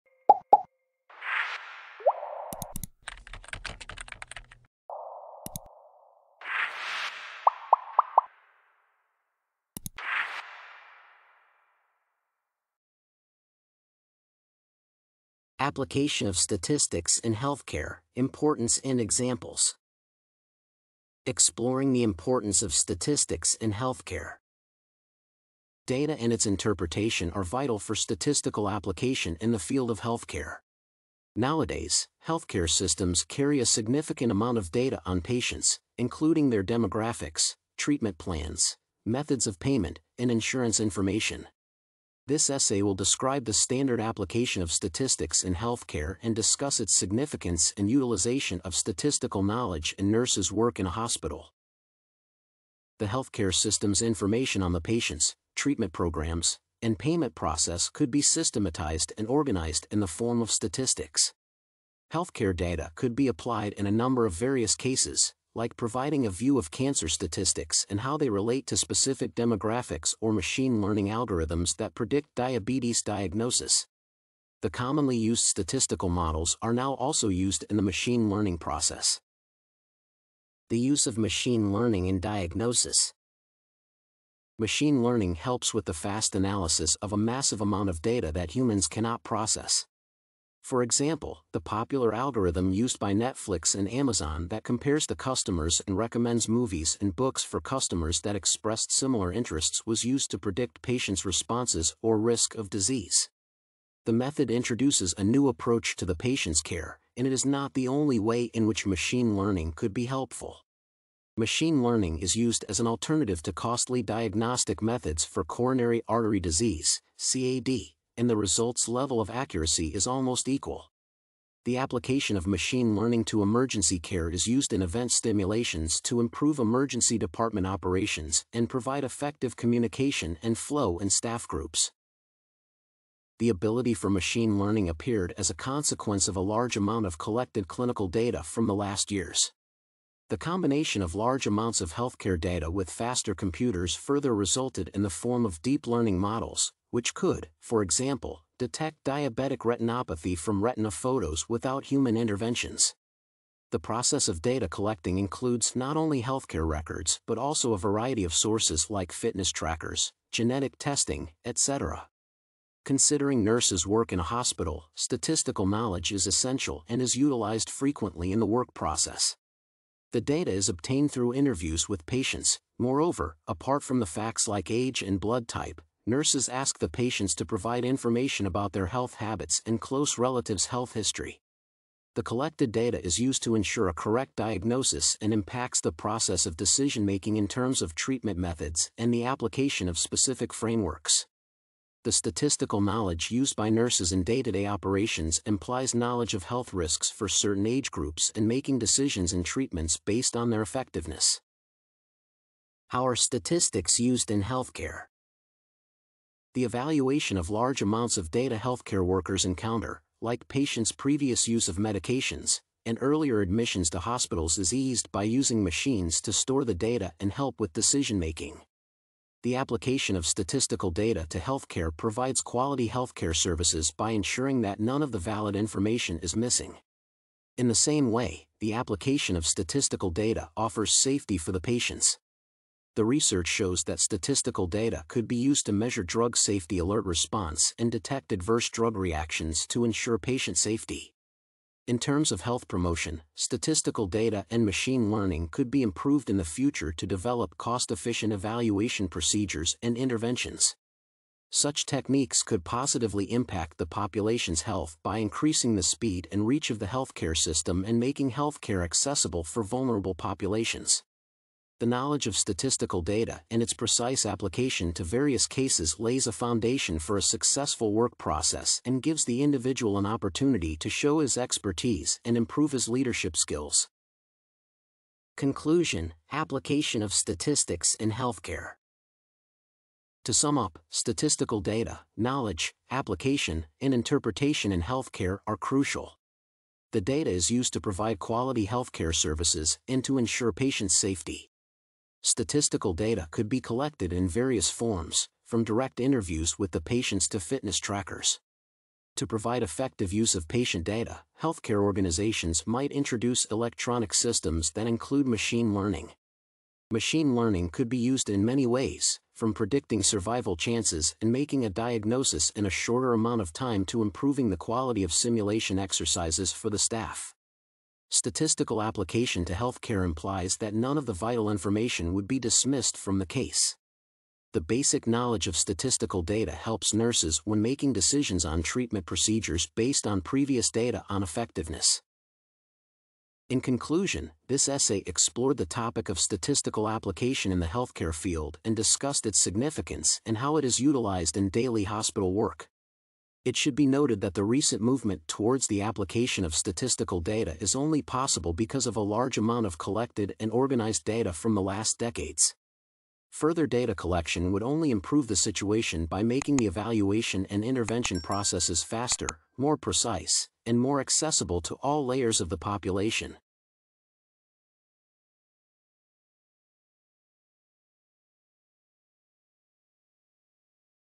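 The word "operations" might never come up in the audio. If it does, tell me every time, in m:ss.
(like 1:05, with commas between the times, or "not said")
2:07, 3:14.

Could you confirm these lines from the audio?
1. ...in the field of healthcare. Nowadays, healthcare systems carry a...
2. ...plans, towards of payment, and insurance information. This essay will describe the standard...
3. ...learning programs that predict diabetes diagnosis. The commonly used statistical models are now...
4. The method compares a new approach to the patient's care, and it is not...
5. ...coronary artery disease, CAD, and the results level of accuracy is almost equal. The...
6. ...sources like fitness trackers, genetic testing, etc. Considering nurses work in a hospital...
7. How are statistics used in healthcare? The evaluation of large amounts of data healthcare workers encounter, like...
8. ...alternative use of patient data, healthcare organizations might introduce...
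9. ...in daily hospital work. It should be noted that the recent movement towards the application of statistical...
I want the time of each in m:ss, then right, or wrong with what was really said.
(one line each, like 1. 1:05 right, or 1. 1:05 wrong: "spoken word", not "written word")
1. 0:29 right
2. 0:38 wrong: "methods", not "towards"
3. 1:10 wrong: "algorithms", not "programs"
4. 1:44 wrong: "introduces", not "compares"
5. 1:55 right
6. 2:38 right
7. 3:22 right
8. 4:59 wrong: "effective", not "alternative"
9. 5:41 right.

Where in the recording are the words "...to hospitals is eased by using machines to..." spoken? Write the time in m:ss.
3:33.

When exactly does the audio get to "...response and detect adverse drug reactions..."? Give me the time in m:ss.
3:57.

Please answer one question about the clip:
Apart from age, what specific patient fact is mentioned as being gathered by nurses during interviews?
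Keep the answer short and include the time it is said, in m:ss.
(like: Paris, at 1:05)
blood type, at 2:55.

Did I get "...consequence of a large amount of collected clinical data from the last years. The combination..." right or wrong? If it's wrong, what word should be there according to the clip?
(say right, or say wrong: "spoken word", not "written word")
right.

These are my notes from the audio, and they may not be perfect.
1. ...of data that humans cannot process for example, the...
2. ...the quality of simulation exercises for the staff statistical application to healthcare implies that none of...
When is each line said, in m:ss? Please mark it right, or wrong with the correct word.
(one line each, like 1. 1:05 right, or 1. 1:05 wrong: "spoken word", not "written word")
1. 1:27 right
2. 5:14 right.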